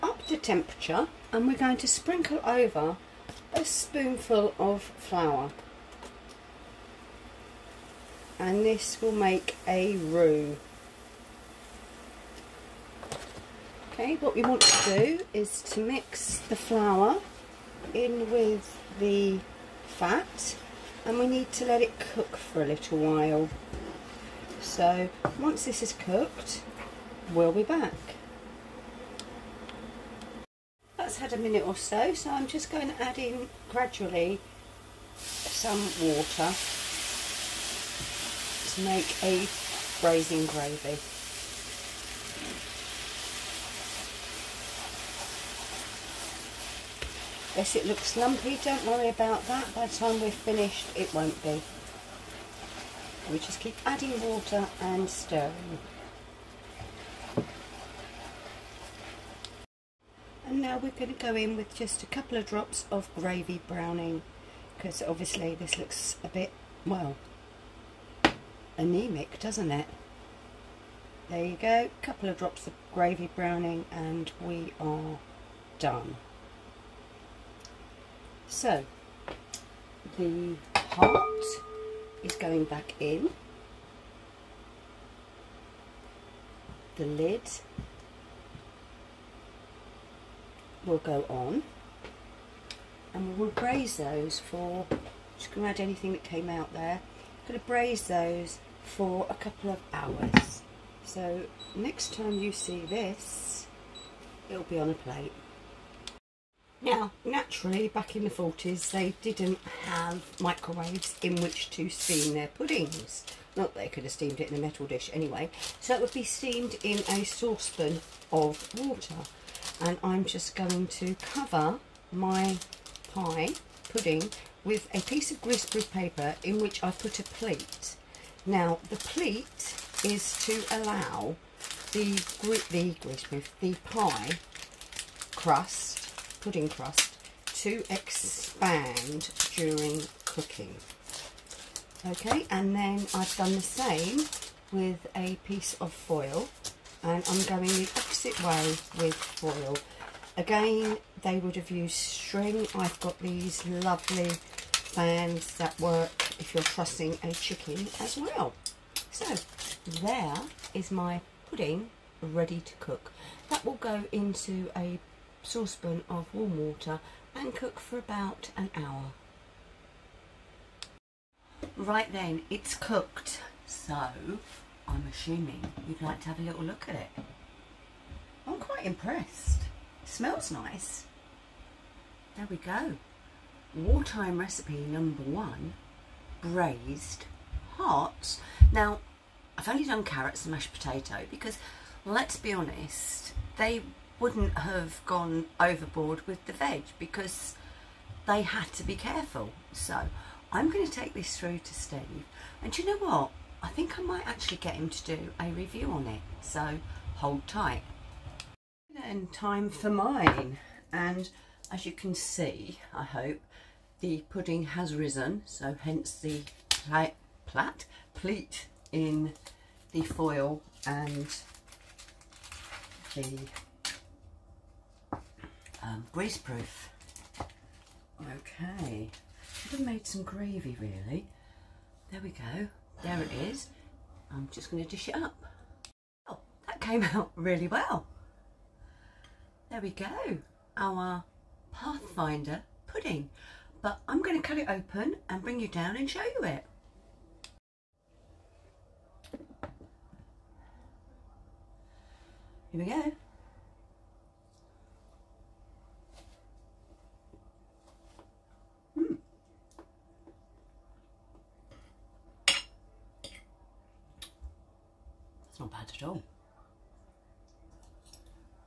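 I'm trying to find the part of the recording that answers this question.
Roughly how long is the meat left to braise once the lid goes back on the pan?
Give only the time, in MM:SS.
01:39.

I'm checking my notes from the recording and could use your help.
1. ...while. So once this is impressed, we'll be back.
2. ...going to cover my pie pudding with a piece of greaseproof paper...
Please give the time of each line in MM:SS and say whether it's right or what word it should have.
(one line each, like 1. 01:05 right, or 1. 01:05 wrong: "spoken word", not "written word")
1. 00:22 wrong: "cooked", not "impressed"
2. 02:00 right.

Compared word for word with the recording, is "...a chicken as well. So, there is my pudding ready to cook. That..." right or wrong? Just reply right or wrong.
right.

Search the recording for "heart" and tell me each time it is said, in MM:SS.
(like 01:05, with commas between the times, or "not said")
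01:20, 03:07.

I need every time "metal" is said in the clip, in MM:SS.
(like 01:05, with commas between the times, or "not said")
01:54.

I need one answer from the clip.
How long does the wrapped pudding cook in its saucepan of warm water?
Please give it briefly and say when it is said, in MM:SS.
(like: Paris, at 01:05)
about an hour, at 02:47.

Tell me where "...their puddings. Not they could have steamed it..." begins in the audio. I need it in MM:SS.
01:52.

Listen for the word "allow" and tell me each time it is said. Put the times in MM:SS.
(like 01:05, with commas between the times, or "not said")
02:10.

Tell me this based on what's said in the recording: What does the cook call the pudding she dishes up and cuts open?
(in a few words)
Pathfinder pudding.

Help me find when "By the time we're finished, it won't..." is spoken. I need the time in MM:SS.
00:49.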